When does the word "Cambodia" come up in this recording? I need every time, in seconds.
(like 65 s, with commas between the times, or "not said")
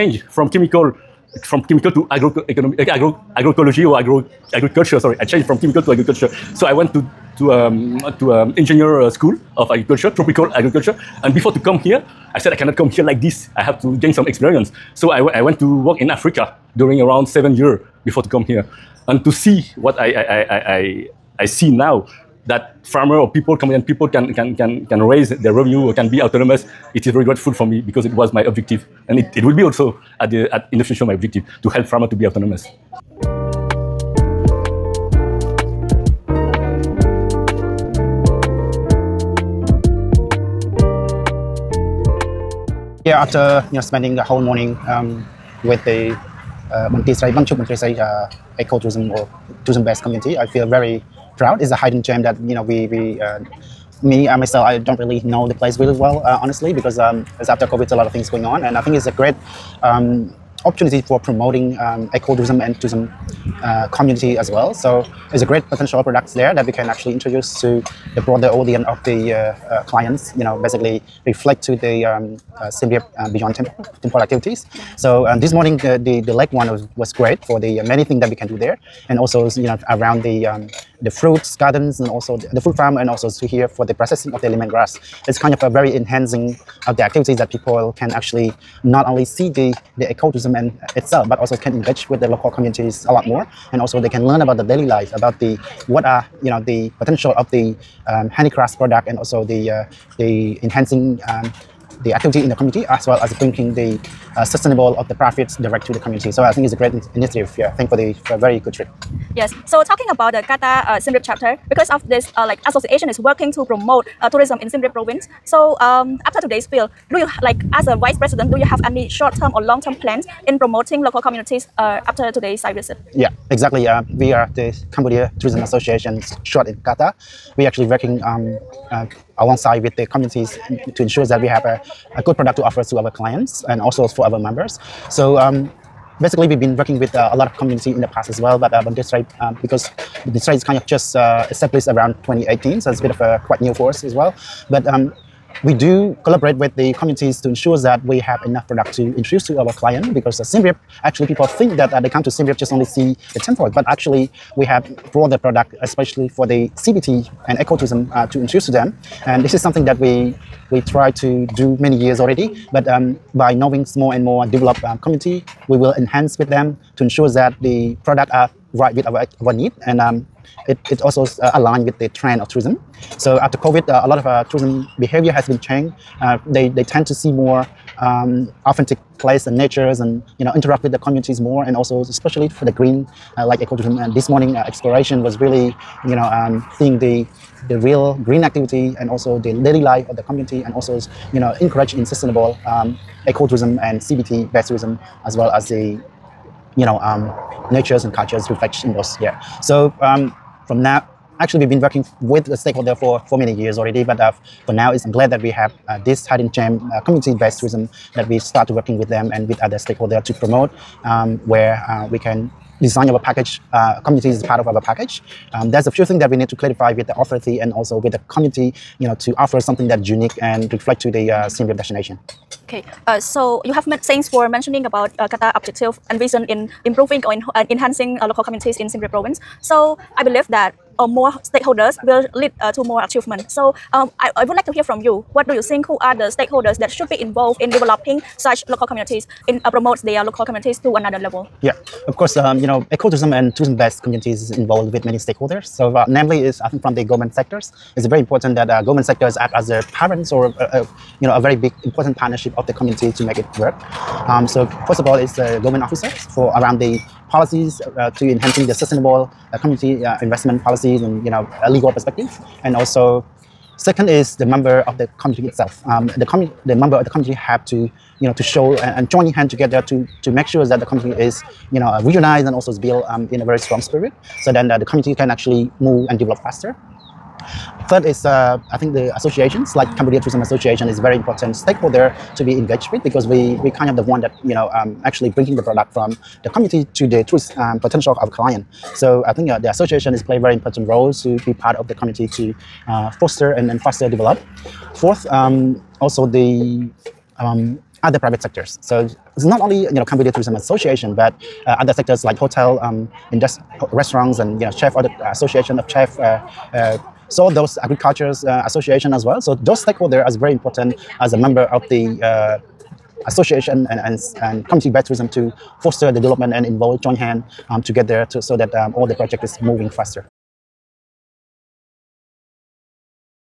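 124 s, 279 s, 300 s.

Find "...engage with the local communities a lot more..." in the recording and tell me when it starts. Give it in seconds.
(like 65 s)
91 s.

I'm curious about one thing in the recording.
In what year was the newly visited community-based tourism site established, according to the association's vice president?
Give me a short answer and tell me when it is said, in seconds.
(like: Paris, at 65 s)
2018, at 142 s.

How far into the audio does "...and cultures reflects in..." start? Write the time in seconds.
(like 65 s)
198 s.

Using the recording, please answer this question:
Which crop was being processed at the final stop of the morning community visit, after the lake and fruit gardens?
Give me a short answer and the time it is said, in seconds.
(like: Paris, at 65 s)
Lemongrass, at 84 s.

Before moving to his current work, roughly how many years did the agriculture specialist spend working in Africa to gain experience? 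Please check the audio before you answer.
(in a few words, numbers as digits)
7.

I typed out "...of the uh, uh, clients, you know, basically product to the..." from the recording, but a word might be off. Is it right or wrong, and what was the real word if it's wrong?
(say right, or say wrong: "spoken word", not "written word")
wrong: "reflect", not "product".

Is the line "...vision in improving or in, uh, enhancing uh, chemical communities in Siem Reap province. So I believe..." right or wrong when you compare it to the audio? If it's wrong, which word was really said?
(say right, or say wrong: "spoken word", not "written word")
wrong: "local", not "chemical".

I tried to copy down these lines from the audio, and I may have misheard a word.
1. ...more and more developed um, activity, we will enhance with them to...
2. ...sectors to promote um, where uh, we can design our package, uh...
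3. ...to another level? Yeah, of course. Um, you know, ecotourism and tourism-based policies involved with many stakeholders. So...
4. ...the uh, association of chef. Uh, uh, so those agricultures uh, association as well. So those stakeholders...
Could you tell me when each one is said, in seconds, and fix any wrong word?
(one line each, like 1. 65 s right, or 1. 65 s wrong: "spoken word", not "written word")
1. 163 s wrong: "community", not "activity"
2. 209 s wrong: "stakeholders", not "sectors"
3. 240 s wrong: "communities", not "policies"
4. 305 s right.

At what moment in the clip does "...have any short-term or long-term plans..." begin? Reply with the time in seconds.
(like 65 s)
118 s.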